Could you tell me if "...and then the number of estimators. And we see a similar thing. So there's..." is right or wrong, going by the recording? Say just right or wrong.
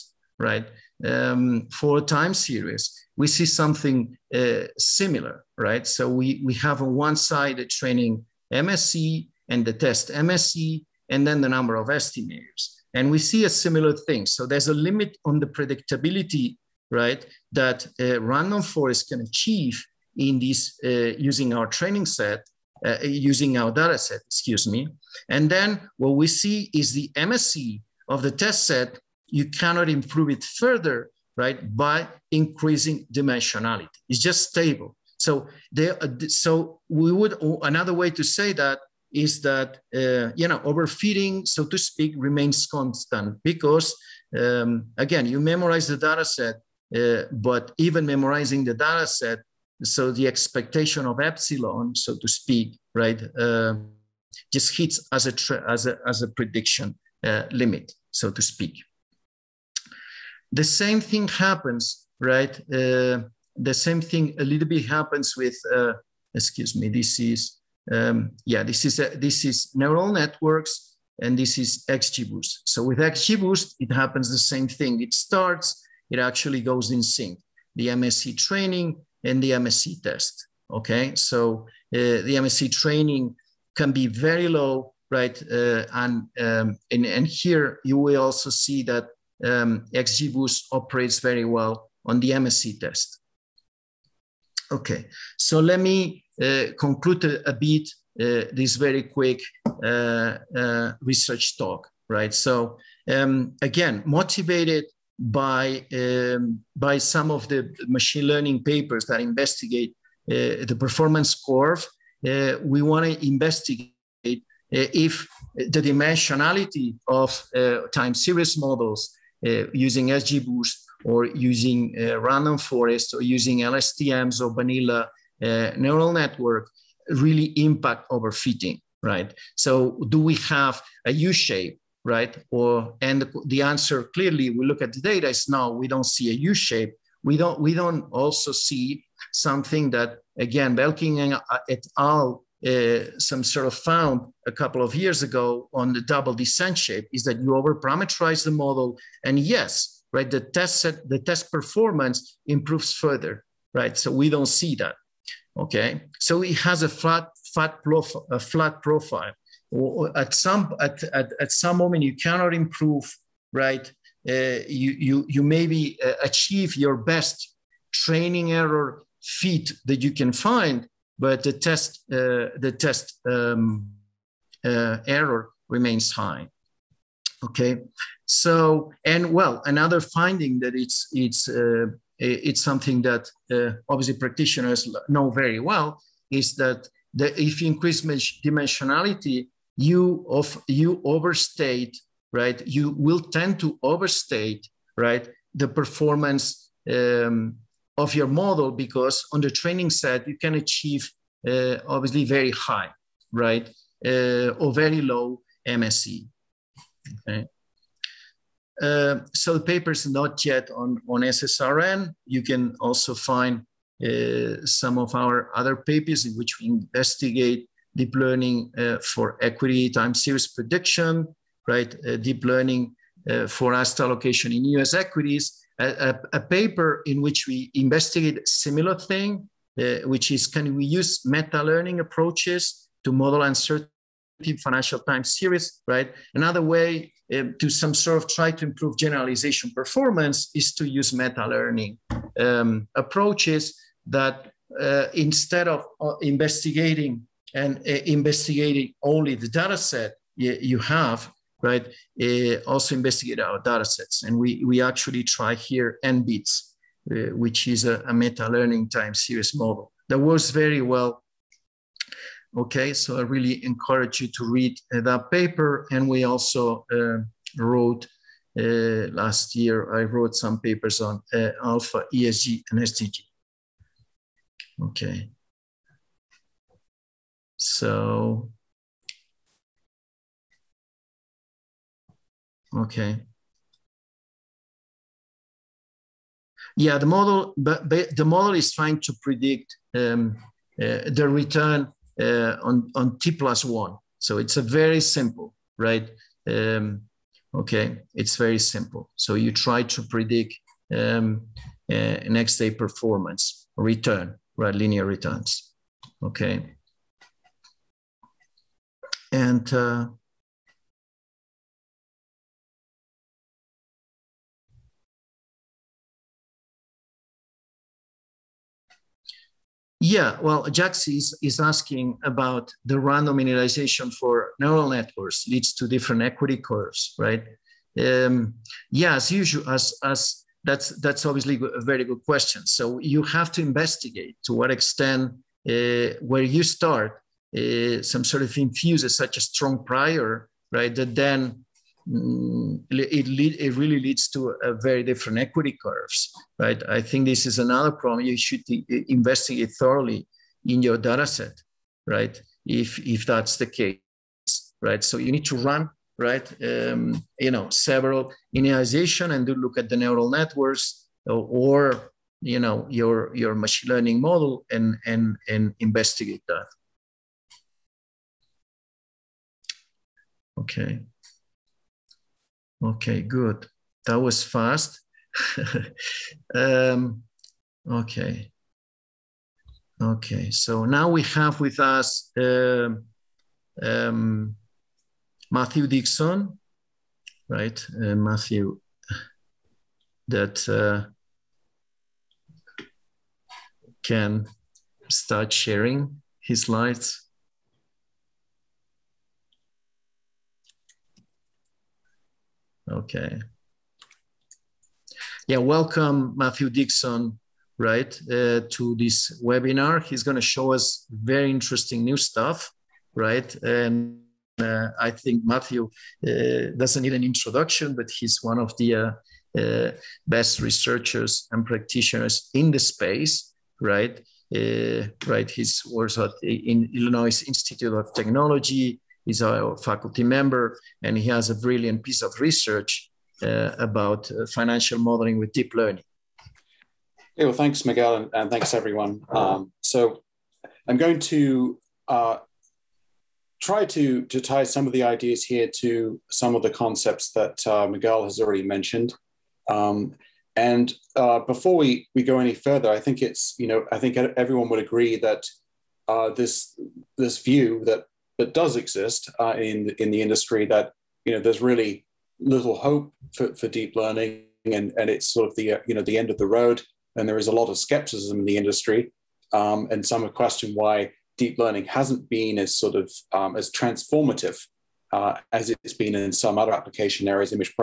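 right.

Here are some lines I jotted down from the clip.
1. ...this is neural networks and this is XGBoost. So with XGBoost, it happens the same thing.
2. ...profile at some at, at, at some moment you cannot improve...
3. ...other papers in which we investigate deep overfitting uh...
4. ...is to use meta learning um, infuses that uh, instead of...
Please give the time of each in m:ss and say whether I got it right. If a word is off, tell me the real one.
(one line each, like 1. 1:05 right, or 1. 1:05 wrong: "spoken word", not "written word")
1. 1:09 right
2. 2:38 right
3. 3:35 wrong: "learning", not "overfitting"
4. 4:00 wrong: "approaches", not "infuses".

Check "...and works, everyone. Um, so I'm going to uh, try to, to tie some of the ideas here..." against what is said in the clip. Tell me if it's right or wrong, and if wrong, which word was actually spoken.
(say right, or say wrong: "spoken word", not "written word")
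wrong: "thanks", not "works".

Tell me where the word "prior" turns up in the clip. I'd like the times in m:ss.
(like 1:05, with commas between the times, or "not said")
5:39.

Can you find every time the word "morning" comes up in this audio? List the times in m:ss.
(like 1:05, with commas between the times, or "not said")
not said.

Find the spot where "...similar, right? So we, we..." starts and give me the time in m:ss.
0:04.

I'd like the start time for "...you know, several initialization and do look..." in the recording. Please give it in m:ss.
5:57.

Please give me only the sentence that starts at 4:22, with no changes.
Okay, so I really encourage you to read uh, that paper.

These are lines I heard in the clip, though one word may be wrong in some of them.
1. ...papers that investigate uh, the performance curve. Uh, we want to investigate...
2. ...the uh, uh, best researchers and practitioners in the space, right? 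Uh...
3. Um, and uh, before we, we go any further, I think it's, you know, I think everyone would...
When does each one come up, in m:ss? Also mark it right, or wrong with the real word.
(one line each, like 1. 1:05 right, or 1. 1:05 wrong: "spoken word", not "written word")
1. 1:48 right
2. 6:58 right
3. 7:29 right.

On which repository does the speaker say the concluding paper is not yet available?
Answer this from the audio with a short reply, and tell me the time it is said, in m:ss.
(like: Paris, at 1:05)
SSRN, at 3:31.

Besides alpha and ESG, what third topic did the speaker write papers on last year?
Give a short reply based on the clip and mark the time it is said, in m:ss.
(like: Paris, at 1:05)
SDG, at 4:32.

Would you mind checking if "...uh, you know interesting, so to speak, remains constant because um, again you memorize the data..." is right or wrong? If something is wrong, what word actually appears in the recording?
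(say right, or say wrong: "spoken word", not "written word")
wrong: "overfitting", not "interesting".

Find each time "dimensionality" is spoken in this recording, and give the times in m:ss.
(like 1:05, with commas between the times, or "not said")
0:33, 1:55, 3:08.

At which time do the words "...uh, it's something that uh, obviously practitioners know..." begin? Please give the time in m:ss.
3:01.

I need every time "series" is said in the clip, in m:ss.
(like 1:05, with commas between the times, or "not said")
0:02, 1:58, 3:40, 3:55, 4:19.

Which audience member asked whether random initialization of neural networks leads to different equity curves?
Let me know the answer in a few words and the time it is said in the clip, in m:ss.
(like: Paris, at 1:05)
Jax, at 5:20.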